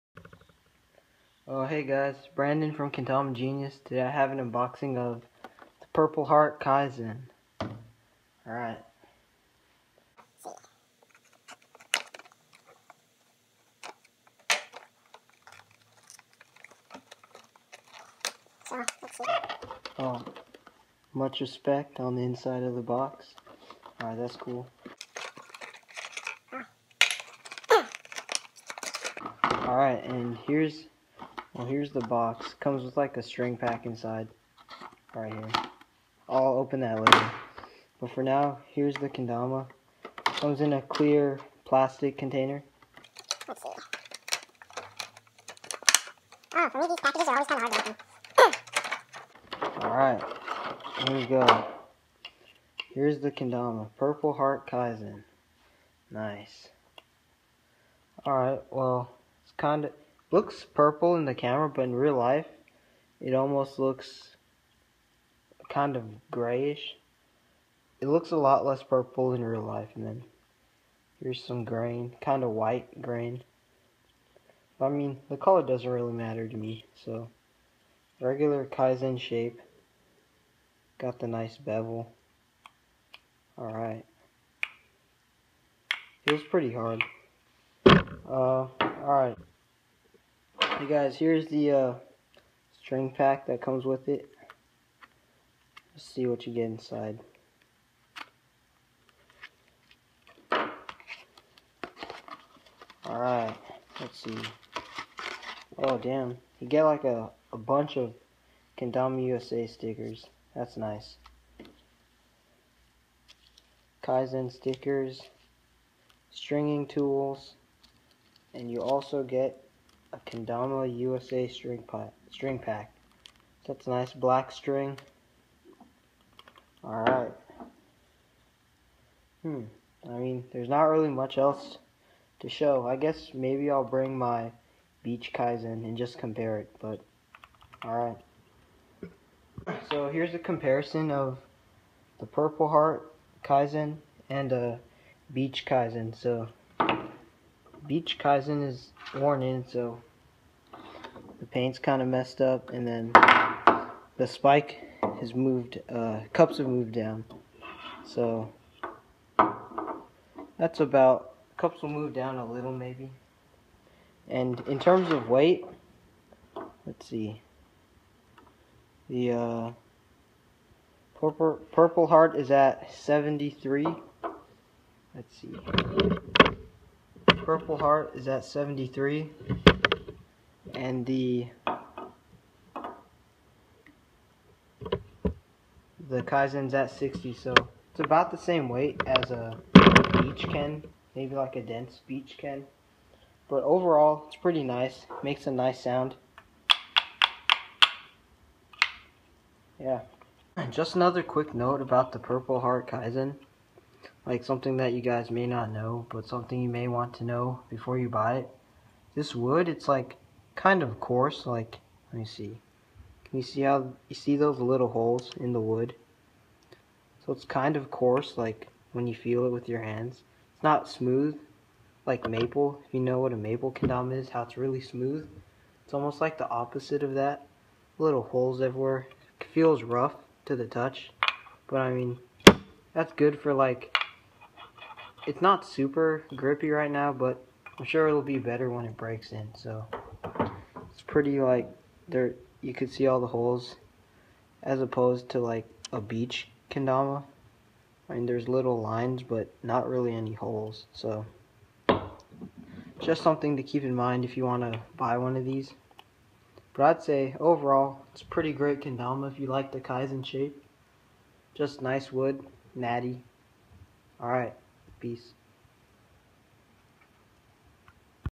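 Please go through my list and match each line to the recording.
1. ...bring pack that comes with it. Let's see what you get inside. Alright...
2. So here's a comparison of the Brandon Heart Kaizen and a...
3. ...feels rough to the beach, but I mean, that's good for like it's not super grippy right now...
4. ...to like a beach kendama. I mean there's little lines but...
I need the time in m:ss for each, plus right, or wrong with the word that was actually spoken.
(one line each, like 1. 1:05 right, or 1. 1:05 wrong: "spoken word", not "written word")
1. 1:32 wrong: "string", not "bring"
2. 2:19 wrong: "Purple", not "Brandon"
3. 3:49 wrong: "touch", not "beach"
4. 4:05 wrong: "beech", not "beach".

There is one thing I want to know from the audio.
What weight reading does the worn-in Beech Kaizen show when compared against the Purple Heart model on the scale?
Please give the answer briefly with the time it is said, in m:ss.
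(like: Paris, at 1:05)
60, at 3:06.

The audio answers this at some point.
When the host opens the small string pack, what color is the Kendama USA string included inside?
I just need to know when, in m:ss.
2:04.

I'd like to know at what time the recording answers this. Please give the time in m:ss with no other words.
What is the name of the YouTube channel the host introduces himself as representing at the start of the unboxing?
0:02.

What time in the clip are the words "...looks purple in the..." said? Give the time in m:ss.
1:00.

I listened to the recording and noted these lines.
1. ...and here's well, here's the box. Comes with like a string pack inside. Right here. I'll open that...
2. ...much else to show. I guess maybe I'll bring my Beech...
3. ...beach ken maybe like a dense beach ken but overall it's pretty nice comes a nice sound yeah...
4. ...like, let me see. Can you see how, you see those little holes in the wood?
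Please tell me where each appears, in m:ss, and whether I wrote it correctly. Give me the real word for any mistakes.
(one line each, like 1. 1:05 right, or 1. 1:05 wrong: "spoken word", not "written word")
1. 0:30 right
2. 2:11 right
3. 3:10 wrong: "makes", not "comes"
4. 3:31 right.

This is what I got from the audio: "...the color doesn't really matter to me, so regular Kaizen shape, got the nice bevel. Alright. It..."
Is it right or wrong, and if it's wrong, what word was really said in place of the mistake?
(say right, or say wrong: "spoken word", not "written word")
right.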